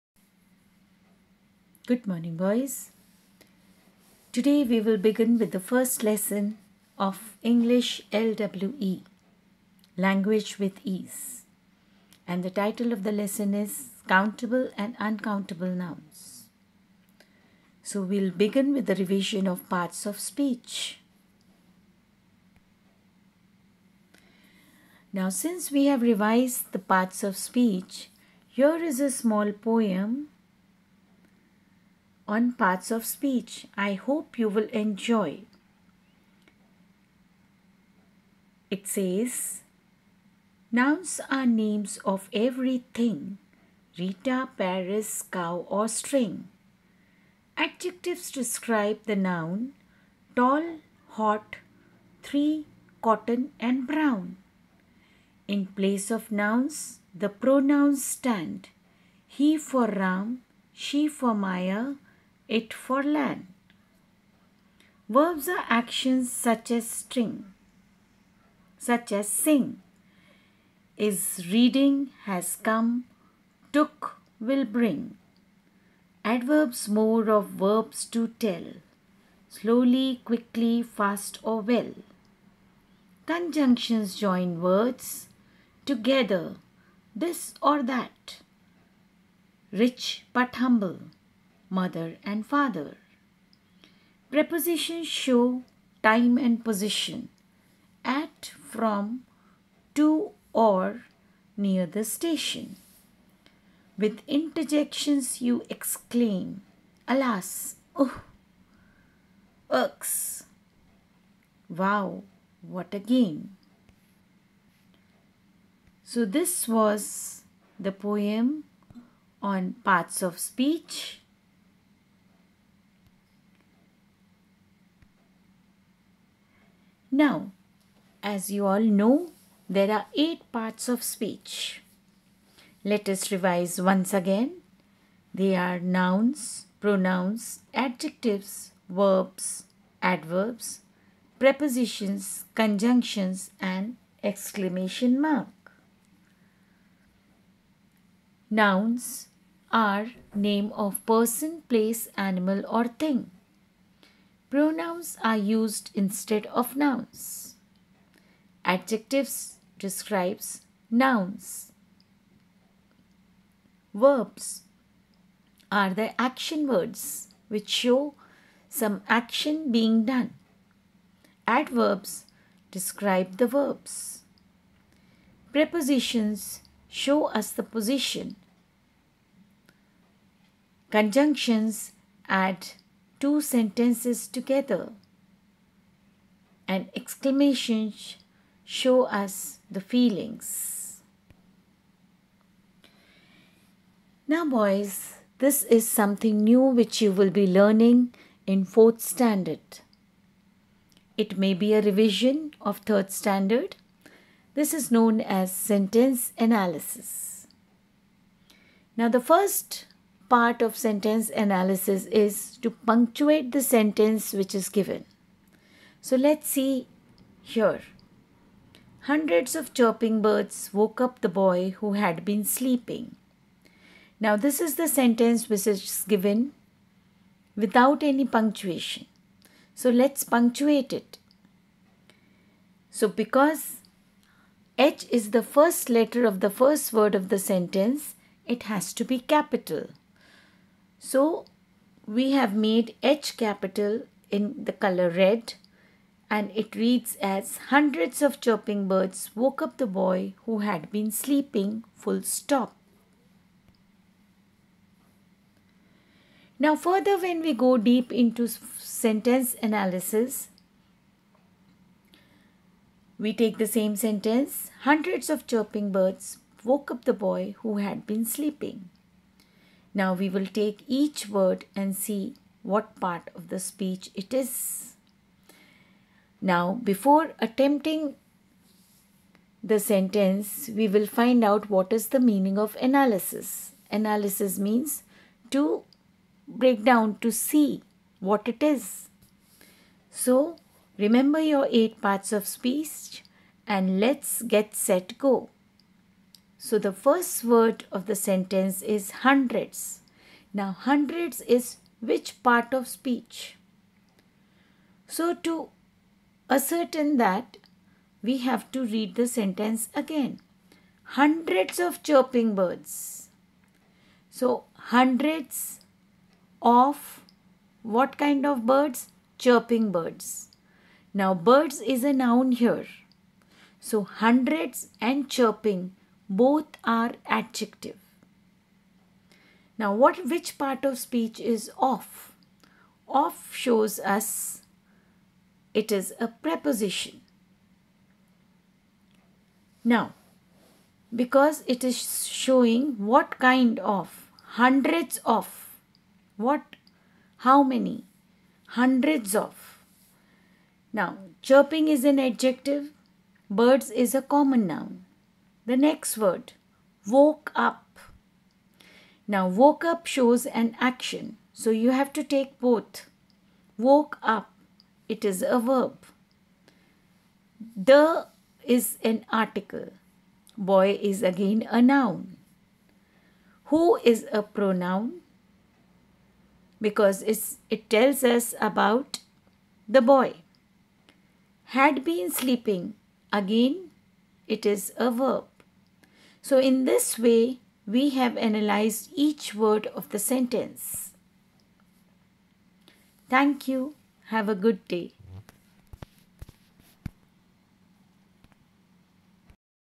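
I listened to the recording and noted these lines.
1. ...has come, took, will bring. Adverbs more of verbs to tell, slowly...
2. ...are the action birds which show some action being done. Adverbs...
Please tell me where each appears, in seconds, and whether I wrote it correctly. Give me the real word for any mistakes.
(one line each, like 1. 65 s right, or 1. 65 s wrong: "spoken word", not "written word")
1. 72 s right
2. 165 s wrong: "words", not "birds".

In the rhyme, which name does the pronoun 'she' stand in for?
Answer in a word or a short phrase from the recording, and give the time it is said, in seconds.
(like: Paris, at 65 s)
Maya, at 61 s.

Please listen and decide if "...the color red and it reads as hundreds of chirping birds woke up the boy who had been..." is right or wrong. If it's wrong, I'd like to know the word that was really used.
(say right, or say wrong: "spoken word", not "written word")
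right.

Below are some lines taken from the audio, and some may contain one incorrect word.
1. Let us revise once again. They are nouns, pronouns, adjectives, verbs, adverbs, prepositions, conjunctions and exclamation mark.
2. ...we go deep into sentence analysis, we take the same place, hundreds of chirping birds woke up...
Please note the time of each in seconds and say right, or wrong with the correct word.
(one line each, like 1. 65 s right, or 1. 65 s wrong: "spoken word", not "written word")
1. 132 s right
2. 257 s wrong: "sentence", not "place".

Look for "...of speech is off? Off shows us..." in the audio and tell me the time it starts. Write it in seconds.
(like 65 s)
330 s.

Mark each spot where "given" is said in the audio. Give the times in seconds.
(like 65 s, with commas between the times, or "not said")
214 s, 226 s.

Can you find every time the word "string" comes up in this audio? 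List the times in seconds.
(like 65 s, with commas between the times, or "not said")
45 s, 66 s.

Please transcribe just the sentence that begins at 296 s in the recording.
So the first word of the sentence is hundreds.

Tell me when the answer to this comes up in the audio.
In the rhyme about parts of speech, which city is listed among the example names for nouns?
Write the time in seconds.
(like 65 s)
44 s.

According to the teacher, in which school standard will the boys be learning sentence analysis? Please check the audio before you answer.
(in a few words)
Fourth standard.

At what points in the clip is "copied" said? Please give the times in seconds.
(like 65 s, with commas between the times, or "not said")
not said.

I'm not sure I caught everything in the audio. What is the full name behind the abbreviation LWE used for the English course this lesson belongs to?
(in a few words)
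Language with Ease.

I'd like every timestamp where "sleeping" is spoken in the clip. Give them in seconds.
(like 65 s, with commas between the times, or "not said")
222 s, 251 s, 268 s, 382 s.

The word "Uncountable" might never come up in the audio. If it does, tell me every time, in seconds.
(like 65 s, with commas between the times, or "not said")
15 s.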